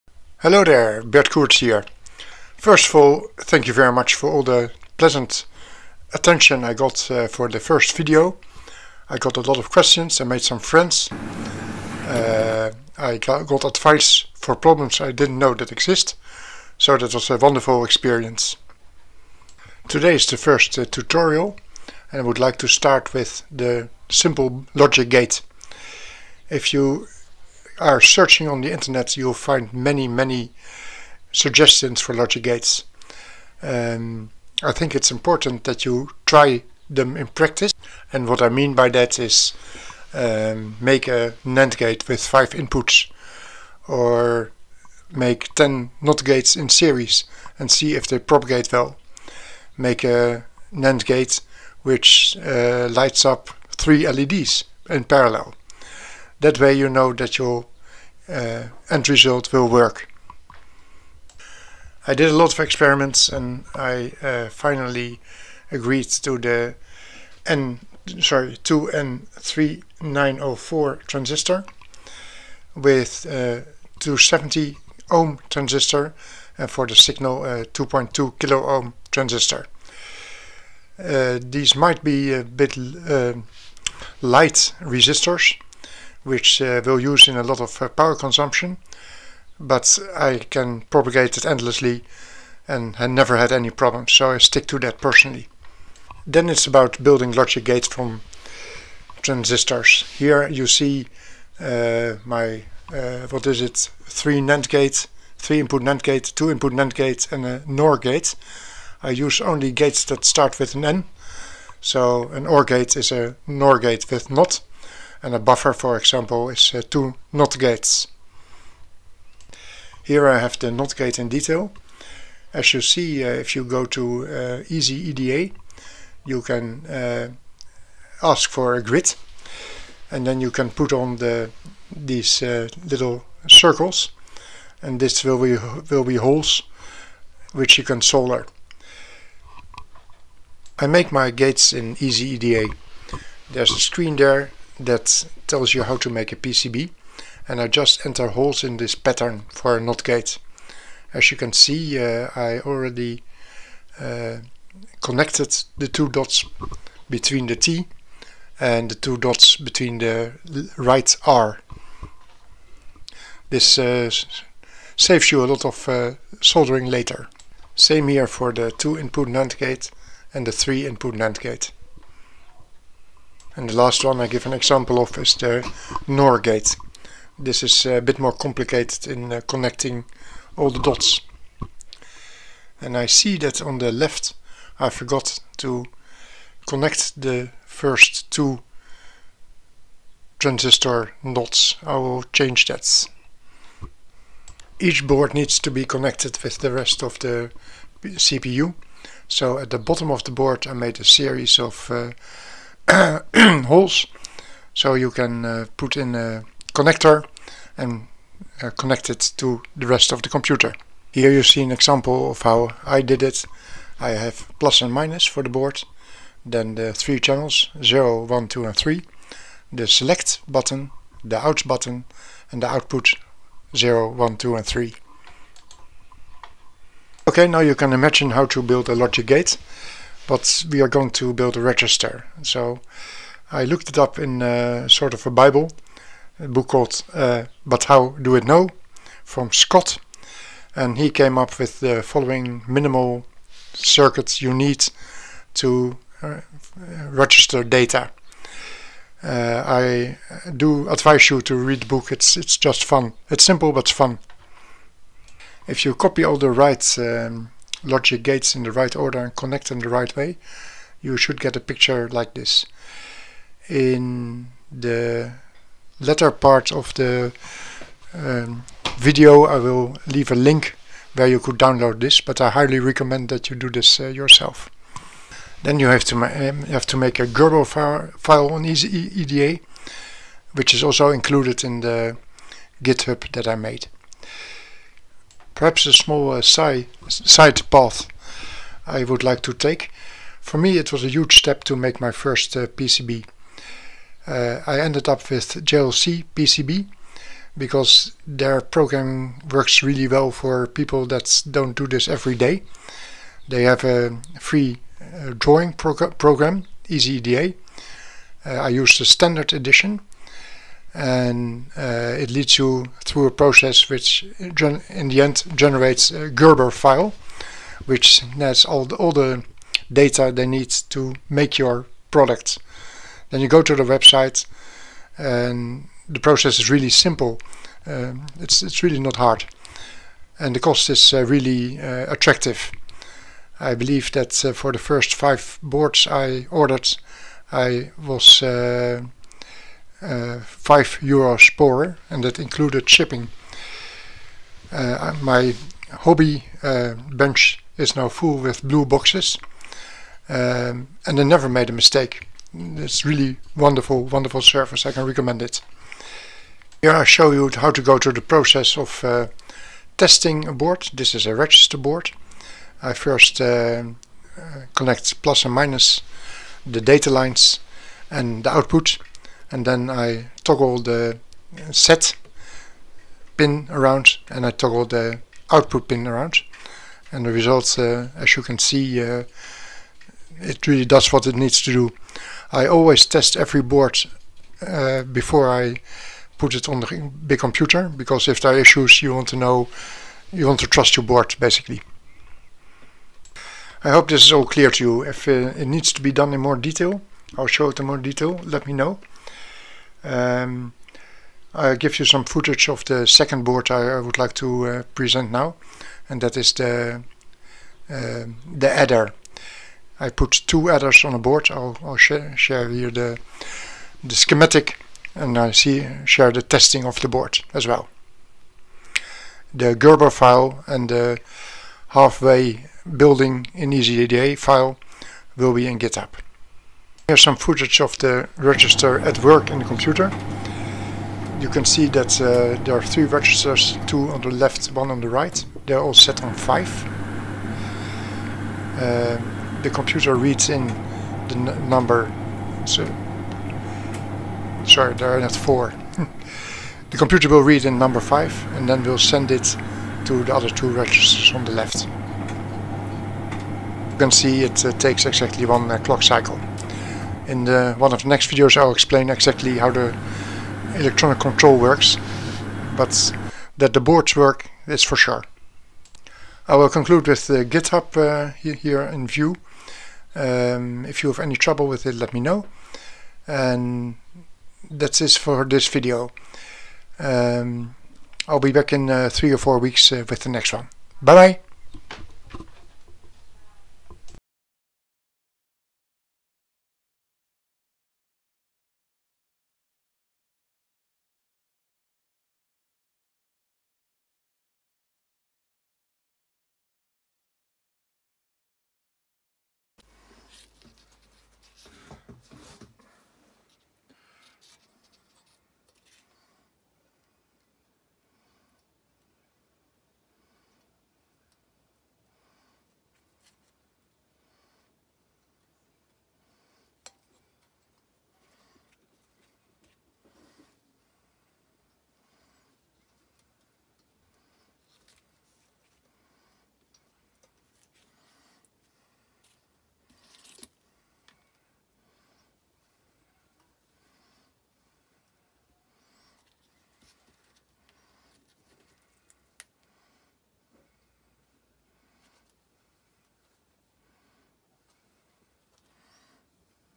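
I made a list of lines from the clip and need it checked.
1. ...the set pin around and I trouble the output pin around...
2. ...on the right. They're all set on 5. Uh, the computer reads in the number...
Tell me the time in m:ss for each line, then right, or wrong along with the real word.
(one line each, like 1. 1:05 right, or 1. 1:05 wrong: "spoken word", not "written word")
1. 6:10 wrong: "toggle", not "trouble"
2. 7:14 right.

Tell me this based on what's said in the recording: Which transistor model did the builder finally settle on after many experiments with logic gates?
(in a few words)
2N3904.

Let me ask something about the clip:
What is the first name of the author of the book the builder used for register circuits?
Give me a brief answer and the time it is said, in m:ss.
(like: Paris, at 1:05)
Scott, at 3:59.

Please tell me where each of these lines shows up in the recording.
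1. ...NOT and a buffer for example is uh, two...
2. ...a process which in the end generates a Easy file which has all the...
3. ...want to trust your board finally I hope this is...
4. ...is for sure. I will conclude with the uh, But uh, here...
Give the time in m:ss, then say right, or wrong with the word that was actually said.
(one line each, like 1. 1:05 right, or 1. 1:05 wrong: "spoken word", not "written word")
1. 1:54 right
2. 5:13 wrong: "Gerber", not "Easy"
3. 6:30 wrong: "basically", not "finally"
4. 7:44 wrong: "GitHub", not "But".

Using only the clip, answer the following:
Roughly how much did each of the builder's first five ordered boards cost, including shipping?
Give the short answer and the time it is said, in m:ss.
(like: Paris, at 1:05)
5 euros, at 5:40.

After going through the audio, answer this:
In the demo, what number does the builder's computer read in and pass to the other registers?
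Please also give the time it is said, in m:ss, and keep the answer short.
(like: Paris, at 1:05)
5, at 7:27.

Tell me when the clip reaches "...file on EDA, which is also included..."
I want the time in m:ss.
4:37.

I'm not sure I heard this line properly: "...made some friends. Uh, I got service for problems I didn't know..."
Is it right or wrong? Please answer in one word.
wrong.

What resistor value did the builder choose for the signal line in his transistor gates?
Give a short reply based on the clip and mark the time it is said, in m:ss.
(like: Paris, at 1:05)
2.2 kilo ohm, at 1:17.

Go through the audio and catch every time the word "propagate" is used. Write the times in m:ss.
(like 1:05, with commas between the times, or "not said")
0:48, 1:30.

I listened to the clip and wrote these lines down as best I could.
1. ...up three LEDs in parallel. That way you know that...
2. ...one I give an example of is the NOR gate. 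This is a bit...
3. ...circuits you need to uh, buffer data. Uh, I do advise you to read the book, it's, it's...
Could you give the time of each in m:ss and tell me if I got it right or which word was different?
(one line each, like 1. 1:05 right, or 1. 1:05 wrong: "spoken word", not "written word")
1. 0:53 right
2. 2:54 right
3. 4:03 wrong: "register", not "buffer".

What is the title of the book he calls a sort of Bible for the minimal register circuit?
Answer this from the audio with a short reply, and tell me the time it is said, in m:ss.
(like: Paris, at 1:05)
But How Do It Know, at 3:57.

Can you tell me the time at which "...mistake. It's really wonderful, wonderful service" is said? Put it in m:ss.
5:51.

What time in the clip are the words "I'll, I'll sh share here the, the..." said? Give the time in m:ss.
6:51.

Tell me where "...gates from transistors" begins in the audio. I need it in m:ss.
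1:37.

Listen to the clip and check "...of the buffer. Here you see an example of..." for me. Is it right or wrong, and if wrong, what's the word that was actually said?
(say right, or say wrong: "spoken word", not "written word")
wrong: "computer", not "buffer".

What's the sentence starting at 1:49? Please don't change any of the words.
I use only gates that start with an N.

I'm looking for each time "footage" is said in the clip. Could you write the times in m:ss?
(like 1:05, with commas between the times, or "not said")
6:42, 7:07.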